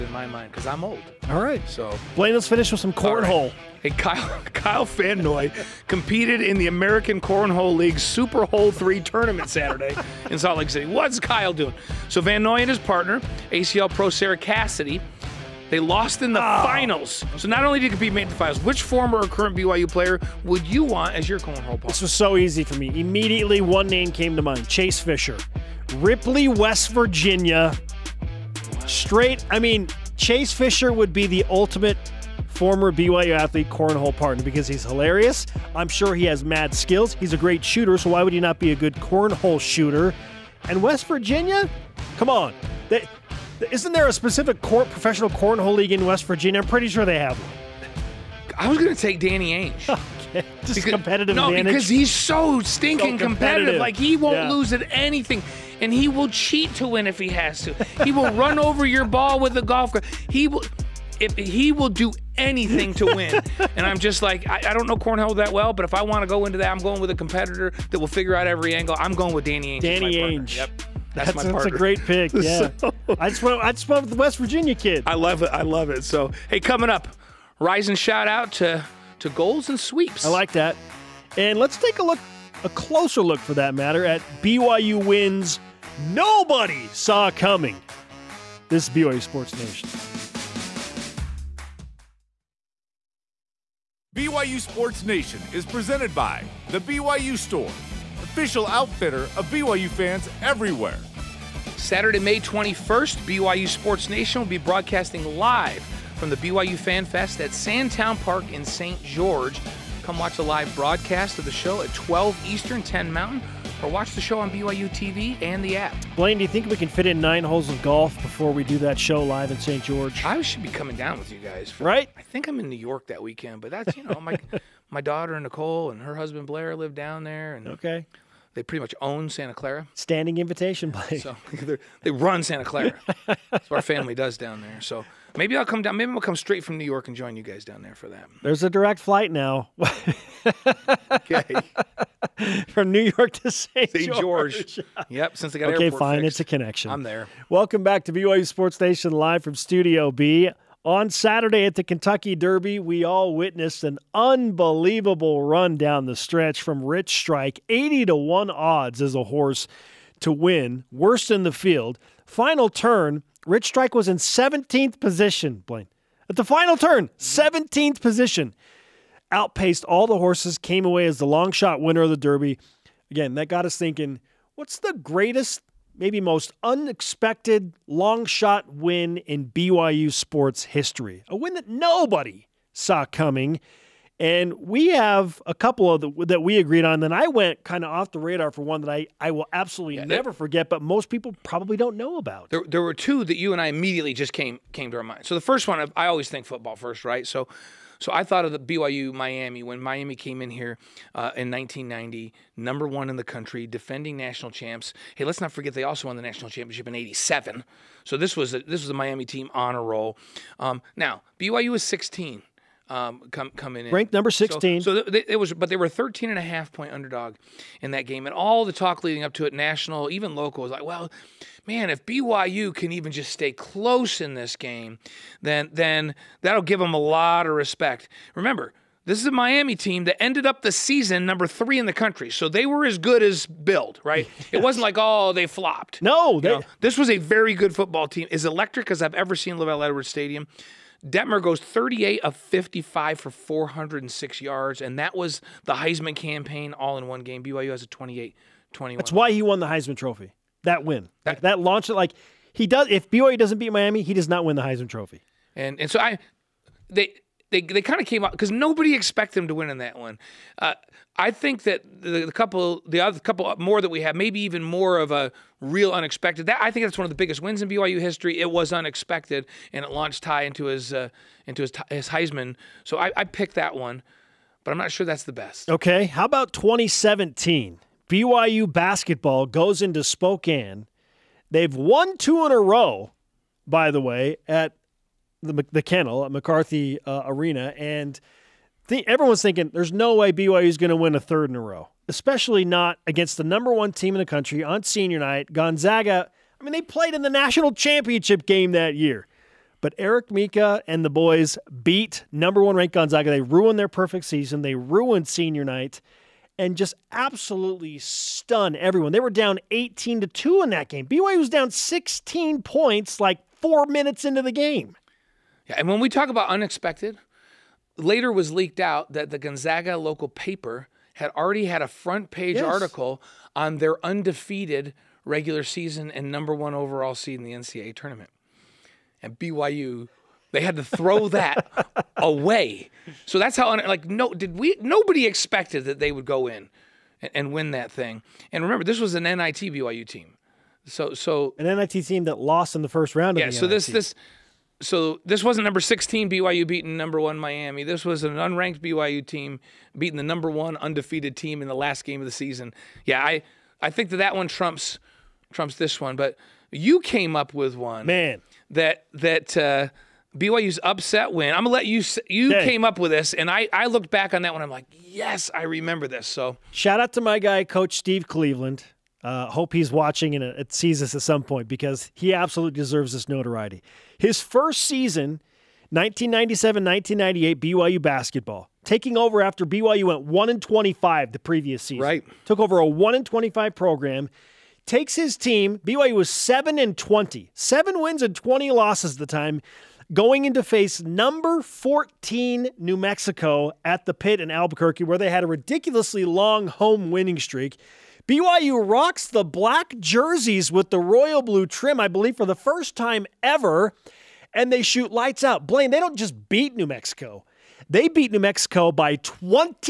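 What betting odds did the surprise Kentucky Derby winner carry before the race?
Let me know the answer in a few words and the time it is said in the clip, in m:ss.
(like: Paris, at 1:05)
80 to 1, at 2:37.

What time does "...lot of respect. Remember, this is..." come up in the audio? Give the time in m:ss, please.
3:46.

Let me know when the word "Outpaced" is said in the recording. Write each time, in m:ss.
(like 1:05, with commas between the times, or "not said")
2:49.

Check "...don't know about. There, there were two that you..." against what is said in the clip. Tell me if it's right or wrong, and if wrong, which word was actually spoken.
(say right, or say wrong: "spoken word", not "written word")
right.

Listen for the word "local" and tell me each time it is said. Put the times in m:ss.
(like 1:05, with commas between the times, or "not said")
3:40, 5:19.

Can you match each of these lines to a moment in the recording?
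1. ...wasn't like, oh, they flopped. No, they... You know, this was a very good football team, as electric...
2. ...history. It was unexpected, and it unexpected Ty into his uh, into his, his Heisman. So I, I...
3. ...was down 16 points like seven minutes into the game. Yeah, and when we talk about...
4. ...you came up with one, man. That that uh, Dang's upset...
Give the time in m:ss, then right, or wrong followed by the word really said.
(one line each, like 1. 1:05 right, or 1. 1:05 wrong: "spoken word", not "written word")
1. 3:54 right
2. 4:28 wrong: "launched", not "unexpected"
3. 5:11 wrong: "four", not "seven"
4. 5:56 wrong: "BYU", not "Dang".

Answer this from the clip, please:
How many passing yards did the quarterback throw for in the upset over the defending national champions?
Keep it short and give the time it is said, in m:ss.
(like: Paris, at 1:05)
406, at 4:03.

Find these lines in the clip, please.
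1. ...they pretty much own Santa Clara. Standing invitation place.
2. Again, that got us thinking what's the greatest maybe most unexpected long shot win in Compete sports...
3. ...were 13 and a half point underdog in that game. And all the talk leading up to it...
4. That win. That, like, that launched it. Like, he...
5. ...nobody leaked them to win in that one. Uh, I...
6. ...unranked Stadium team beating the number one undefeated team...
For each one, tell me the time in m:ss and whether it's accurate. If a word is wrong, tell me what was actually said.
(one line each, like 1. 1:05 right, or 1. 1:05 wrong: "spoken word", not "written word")
1. 2:08 right
2. 2:53 wrong: "BYU", not "Compete"
3. 3:35 right
4. 4:10 right
5. 4:18 wrong: "expected", not "leaked"
6. 5:48 wrong: "BYU", not "Stadium".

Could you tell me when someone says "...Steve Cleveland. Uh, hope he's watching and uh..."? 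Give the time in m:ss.
6:07.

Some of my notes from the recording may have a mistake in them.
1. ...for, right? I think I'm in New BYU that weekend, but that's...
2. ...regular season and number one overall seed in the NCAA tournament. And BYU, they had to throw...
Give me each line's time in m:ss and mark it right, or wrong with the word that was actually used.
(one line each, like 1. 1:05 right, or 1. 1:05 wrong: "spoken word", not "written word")
1. 2:01 wrong: "York", not "BYU"
2. 5:25 right.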